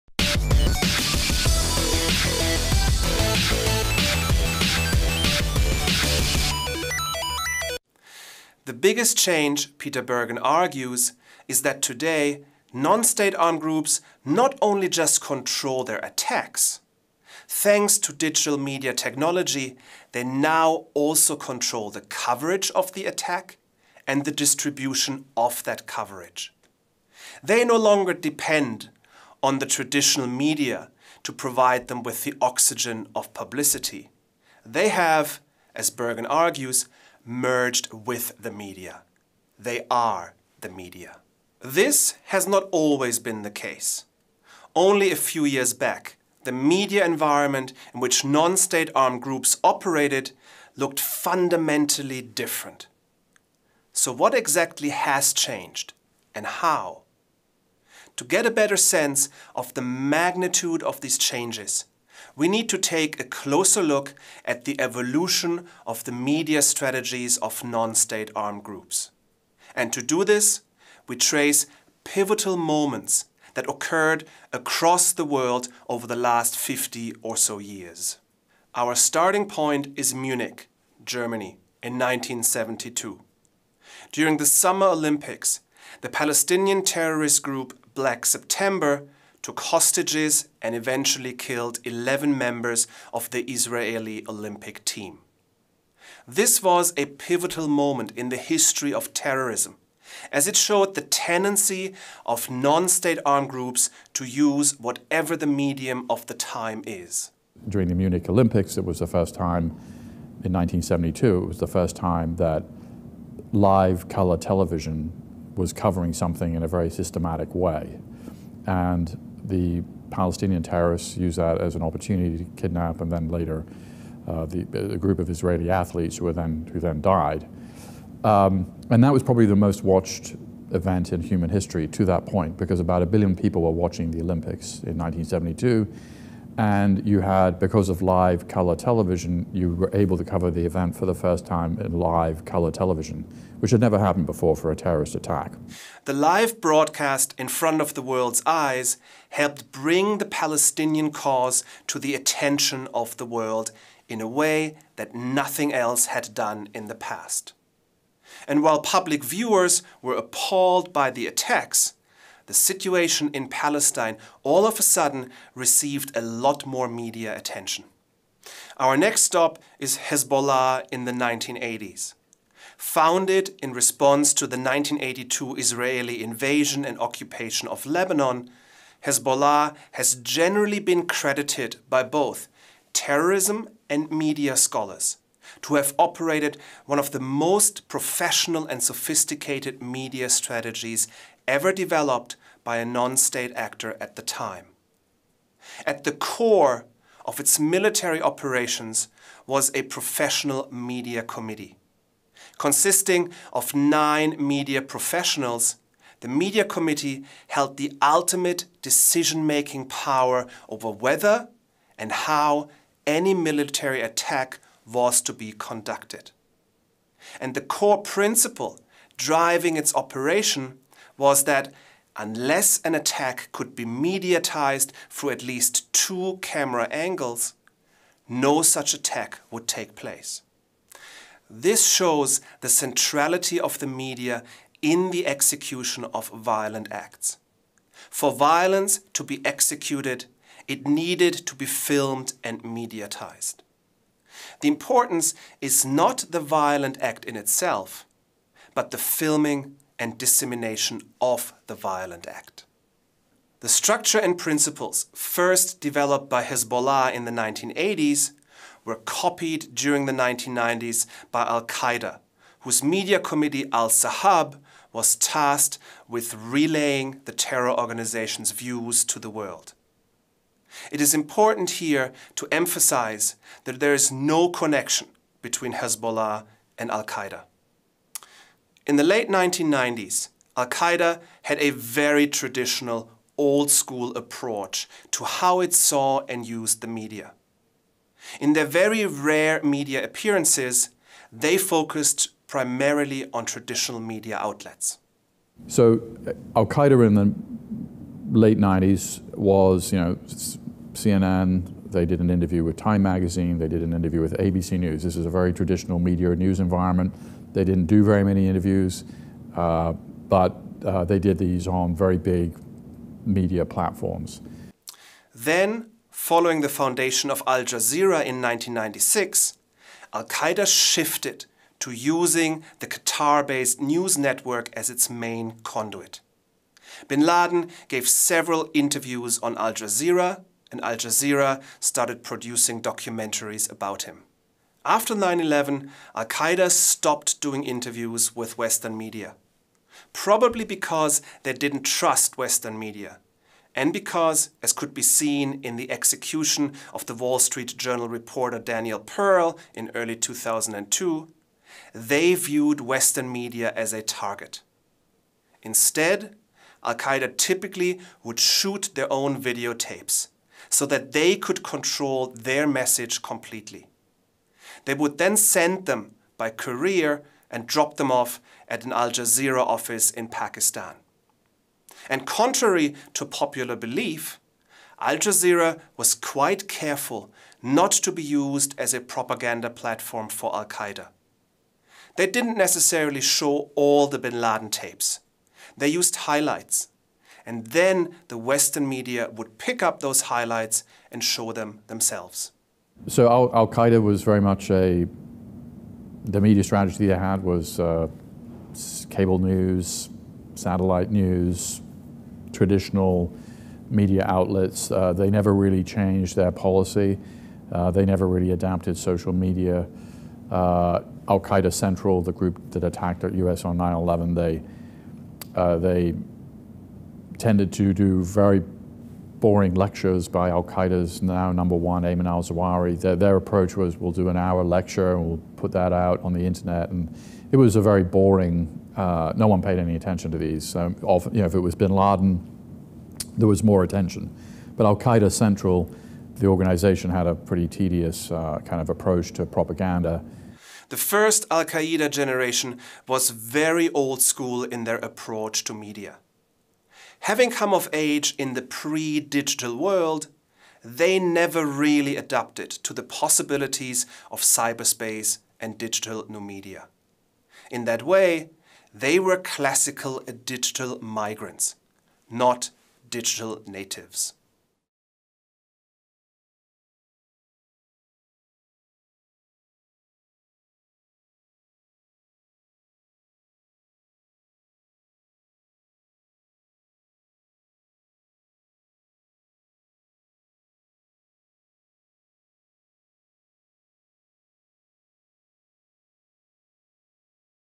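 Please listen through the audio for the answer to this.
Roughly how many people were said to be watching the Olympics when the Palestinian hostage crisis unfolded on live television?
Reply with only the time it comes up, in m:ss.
2:12.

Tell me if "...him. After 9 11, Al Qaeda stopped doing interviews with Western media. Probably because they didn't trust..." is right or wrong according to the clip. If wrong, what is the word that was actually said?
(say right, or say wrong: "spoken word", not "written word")
right.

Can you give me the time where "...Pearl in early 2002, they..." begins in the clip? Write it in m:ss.
5:48.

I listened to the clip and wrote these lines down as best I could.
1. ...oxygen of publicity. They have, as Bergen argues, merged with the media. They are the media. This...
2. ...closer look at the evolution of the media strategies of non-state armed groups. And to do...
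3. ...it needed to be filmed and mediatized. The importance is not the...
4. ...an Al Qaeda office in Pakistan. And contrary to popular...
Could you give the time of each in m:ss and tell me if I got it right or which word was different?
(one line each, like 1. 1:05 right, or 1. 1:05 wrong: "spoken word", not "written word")
1. 0:32 right
2. 1:03 right
3. 4:00 right
4. 6:08 wrong: "Jazeera", not "Qaeda".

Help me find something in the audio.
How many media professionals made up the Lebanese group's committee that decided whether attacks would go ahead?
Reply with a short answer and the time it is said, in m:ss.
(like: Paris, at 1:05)
9, at 3:23.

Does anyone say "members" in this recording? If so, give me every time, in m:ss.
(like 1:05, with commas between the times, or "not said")
1:32.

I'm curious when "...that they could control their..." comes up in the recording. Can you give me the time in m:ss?
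6:00.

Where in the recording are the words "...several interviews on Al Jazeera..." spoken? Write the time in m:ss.
5:28.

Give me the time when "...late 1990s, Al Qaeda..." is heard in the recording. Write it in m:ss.
4:39.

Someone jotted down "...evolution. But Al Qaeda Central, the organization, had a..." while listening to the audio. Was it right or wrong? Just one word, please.
wrong.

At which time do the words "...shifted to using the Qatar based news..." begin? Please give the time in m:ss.
5:20.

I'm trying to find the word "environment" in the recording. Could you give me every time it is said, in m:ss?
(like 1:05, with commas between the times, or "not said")
0:47, 5:06.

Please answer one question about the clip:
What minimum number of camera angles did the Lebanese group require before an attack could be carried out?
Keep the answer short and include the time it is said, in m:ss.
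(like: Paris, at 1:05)
2, at 3:45.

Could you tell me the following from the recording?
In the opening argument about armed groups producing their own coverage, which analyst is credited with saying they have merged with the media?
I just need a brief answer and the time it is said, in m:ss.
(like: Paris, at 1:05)
Peter Bergen, at 0:09.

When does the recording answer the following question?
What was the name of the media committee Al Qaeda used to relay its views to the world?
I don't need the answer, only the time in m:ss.
4:23.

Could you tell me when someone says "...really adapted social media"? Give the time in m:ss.
6:48.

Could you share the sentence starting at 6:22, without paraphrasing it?
They didn't necessarily show all the bin Laden tapes.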